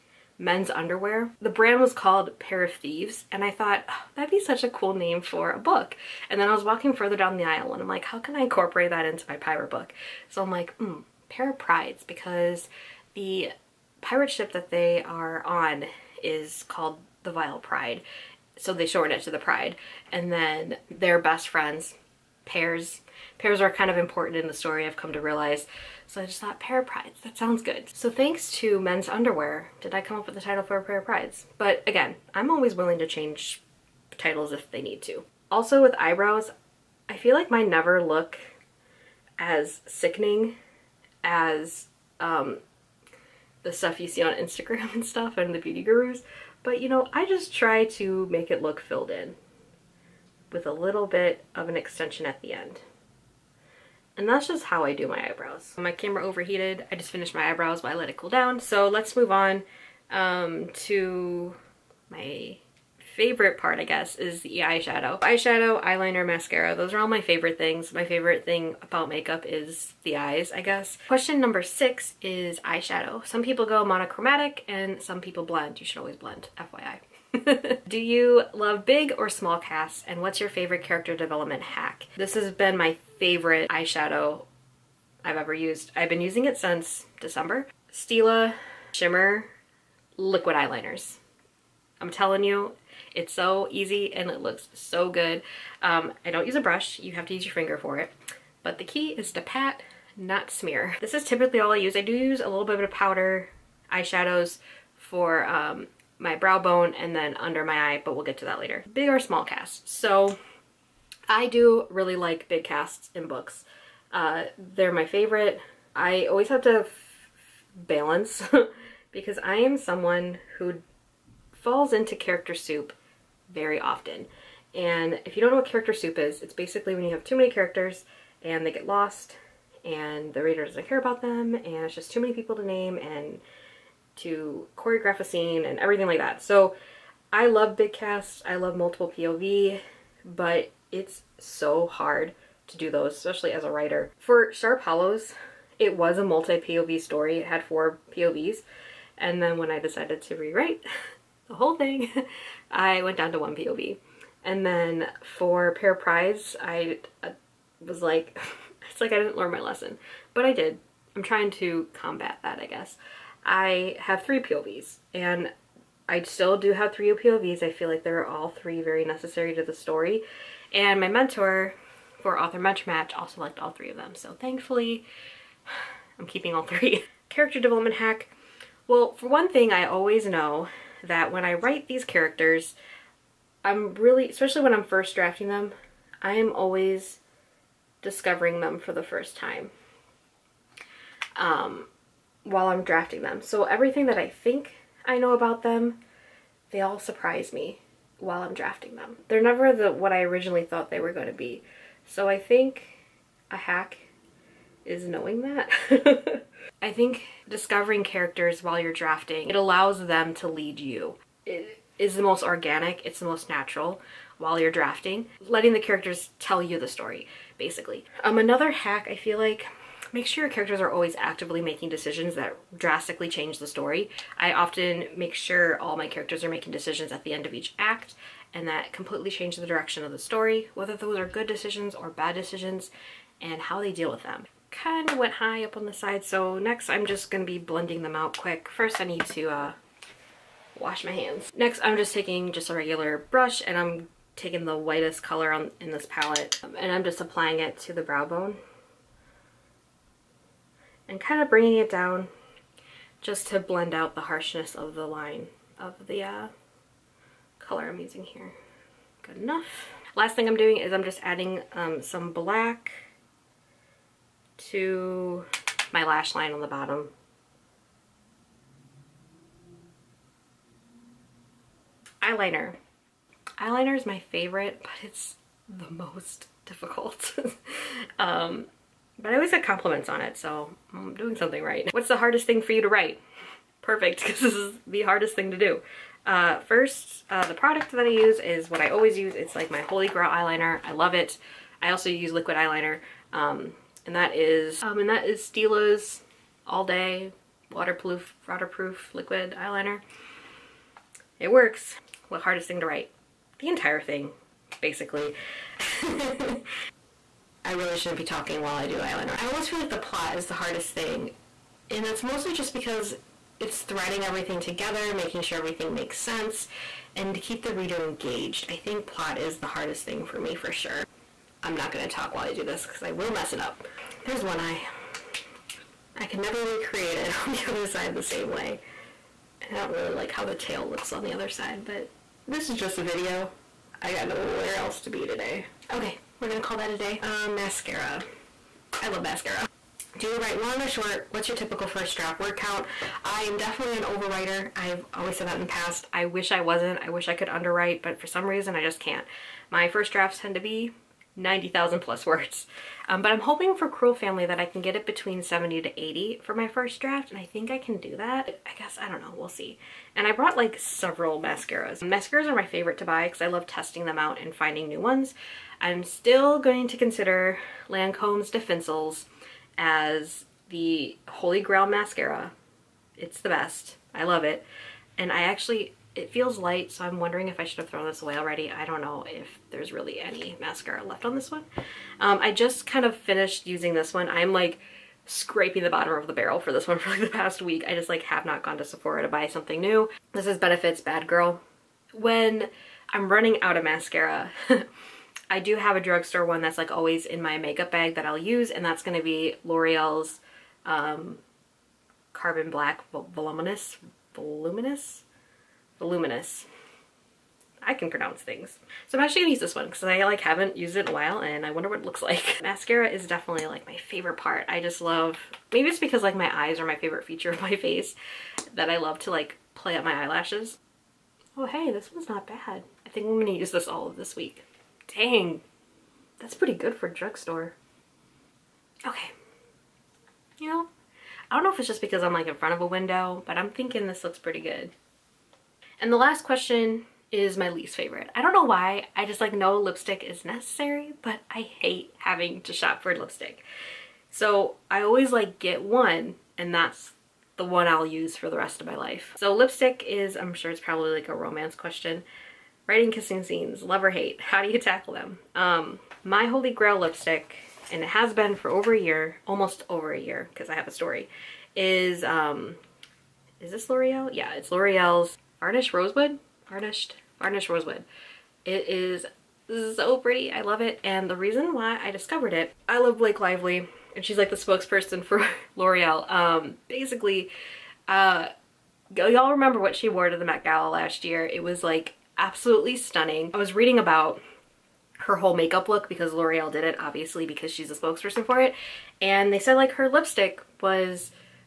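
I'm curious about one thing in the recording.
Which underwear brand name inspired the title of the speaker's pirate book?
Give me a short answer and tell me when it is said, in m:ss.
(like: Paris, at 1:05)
Pair of Thieves, at 0:02.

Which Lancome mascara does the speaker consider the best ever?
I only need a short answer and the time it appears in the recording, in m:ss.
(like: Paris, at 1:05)
Définicils, at 6:08.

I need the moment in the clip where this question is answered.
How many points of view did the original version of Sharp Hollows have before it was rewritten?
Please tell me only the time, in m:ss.
2:27.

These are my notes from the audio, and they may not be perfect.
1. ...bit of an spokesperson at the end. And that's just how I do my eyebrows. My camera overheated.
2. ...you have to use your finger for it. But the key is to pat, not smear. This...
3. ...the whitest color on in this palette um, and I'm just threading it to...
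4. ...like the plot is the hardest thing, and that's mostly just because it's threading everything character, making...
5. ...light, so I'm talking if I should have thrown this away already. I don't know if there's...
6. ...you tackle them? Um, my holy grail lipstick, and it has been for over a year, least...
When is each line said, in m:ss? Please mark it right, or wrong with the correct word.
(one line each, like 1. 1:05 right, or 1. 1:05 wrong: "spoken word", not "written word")
1. 0:51 wrong: "extension", not "spokesperson"
2. 1:36 right
3. 4:04 wrong: "applying", not "threading"
4. 5:09 wrong: "together", not "character"
5. 6:16 wrong: "wondering", not "talking"
6. 7:34 wrong: "almost", not "least".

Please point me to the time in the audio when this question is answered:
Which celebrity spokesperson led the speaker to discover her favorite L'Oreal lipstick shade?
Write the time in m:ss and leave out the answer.
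7:53.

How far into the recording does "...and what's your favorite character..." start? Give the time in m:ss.
1:20.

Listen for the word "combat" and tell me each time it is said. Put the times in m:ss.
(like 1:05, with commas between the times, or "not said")
2:41.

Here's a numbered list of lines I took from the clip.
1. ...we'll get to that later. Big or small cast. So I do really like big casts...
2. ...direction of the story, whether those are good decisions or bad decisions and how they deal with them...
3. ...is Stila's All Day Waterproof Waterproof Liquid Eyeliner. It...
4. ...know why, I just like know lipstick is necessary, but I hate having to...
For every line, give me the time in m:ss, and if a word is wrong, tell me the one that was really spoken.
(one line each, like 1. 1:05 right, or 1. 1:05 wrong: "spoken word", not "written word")
1. 1:48 right
2. 3:49 right
3. 4:55 right
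4. 7:18 right.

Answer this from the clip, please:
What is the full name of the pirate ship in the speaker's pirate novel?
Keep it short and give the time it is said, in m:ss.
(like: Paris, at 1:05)
Vile Pride, at 0:17.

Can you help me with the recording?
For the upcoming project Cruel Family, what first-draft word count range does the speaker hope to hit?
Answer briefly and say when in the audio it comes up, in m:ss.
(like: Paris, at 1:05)
70,000 to 80,000, at 5:55.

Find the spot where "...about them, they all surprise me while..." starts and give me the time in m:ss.
3:15.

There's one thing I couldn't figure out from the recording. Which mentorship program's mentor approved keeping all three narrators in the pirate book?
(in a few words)
Author Match.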